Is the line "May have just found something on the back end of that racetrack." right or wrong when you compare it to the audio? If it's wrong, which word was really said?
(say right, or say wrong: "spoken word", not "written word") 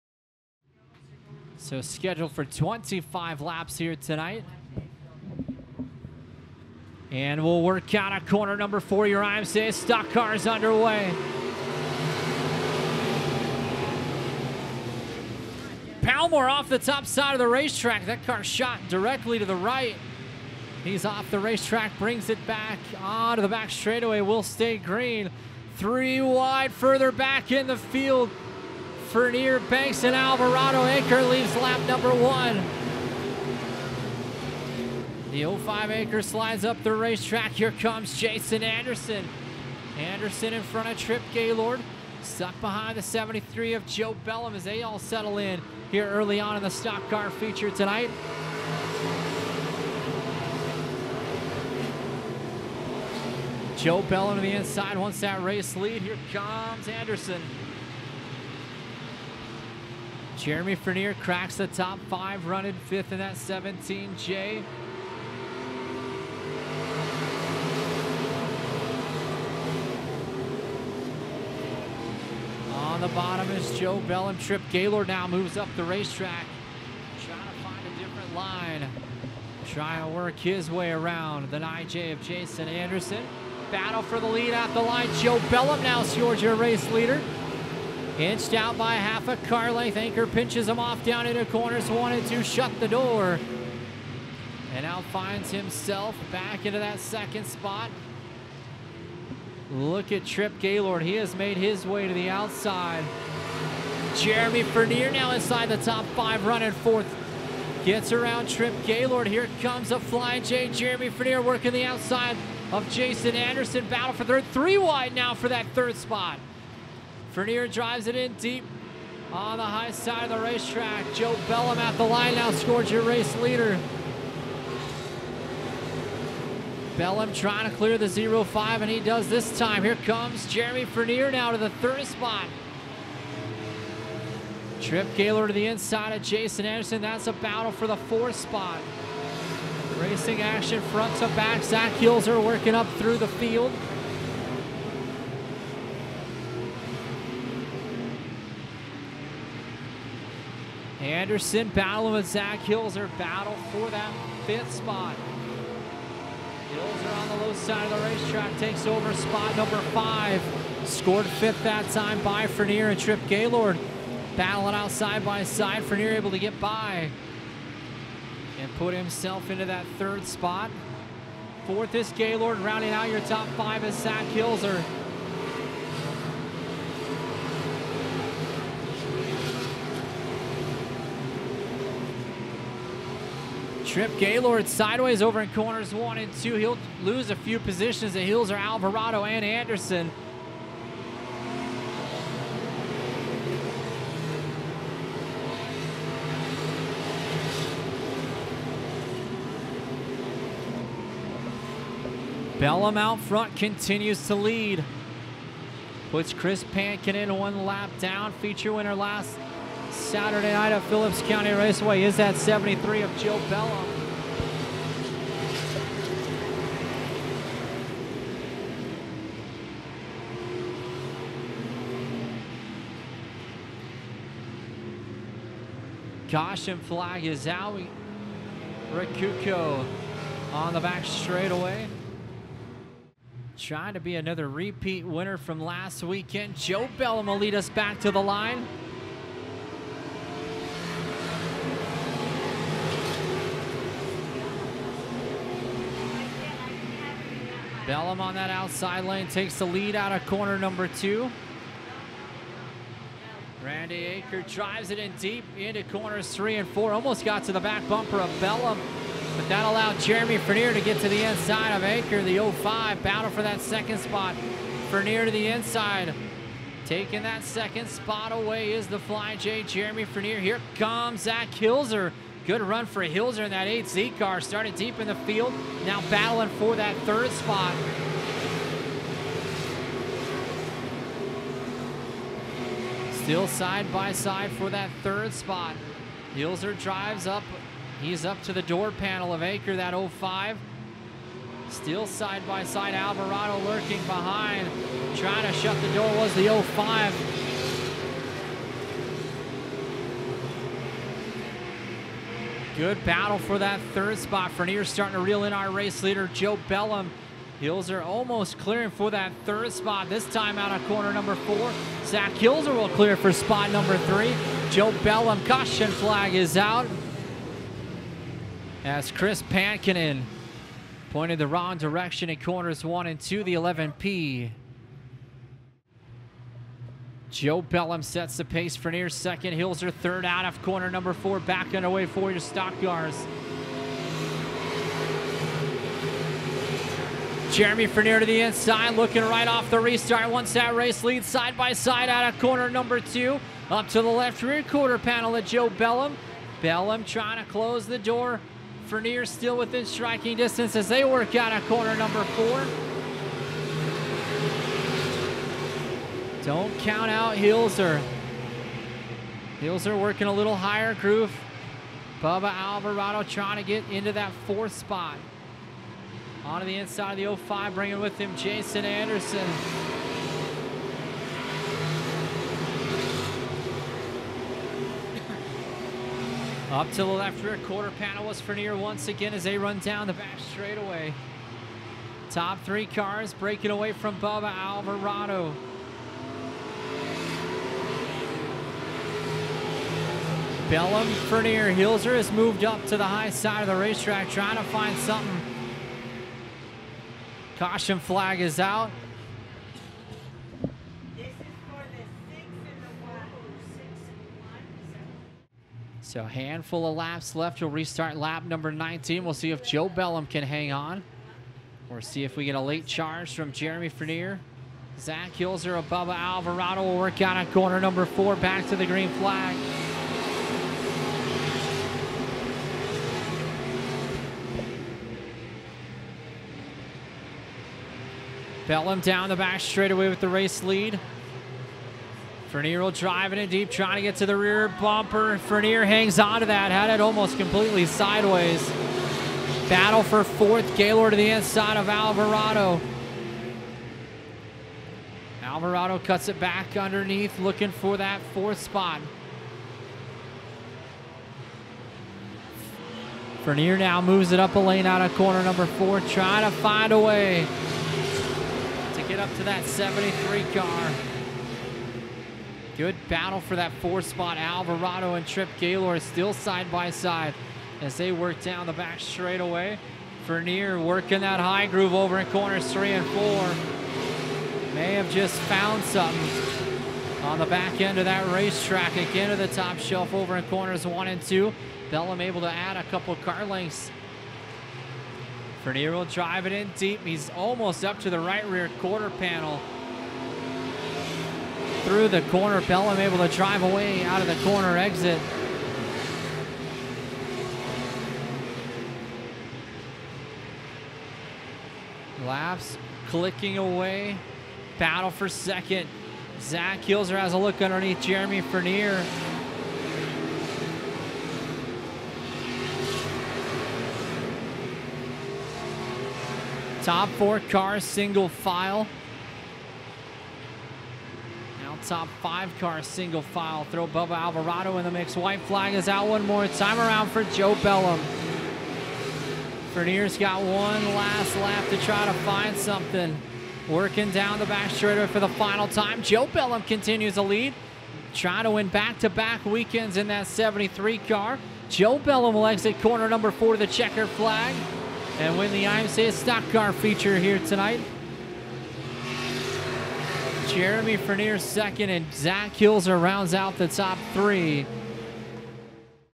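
right.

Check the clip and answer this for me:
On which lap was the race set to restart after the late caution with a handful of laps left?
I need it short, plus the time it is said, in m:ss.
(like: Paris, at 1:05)
19, at 6:48.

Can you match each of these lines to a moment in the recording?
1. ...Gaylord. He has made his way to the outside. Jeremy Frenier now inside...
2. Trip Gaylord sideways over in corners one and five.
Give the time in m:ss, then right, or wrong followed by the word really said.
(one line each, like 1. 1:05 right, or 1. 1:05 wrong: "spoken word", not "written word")
1. 1:40 wrong: "Fernier", not "Frenier"
2. 3:03 wrong: "two", not "five".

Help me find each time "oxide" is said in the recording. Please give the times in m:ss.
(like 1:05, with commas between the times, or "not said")
not said.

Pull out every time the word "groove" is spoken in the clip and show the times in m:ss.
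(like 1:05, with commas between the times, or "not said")
6:00, 7:51.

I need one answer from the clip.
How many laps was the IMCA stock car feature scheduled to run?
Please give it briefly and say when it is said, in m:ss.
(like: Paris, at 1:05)
25, at 0:02.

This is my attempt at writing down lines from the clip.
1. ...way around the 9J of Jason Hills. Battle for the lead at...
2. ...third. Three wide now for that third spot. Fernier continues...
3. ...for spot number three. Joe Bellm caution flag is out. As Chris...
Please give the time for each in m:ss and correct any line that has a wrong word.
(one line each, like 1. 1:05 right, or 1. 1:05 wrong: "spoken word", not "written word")
1. 1:20 wrong: "Anderson", not "Hills"
2. 1:54 wrong: "drives", not "continues"
3. 5:13 right.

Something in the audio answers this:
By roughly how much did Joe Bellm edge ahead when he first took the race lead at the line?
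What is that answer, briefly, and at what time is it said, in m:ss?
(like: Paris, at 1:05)
Half a car length, at 1:28.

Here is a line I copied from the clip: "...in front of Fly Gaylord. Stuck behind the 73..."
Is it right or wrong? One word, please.
wrong.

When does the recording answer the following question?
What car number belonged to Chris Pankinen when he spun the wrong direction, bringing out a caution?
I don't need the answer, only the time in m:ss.
5:23.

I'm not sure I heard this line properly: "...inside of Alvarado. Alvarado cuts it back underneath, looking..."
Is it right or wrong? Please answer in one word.
right.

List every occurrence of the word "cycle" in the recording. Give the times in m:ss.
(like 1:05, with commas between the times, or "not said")
not said.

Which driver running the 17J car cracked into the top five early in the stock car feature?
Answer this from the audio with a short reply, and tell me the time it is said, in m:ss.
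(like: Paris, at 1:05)
Jeremy Frenier, at 1:00.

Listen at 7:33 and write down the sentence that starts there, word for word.
Fernier now moves it up a lane out of corner number four, trying to find a way.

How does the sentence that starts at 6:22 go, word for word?
Top three cars breaking away from Bubba Alvarado.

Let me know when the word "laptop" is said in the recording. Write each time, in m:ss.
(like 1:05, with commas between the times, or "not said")
not said.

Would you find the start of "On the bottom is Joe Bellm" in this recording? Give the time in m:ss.
1:12.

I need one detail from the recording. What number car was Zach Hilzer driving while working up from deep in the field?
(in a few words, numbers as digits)
8Z.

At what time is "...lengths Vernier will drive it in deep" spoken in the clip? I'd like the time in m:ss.
8:03.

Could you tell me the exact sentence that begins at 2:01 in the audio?
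Joe Bellm at the line now scores your race leader.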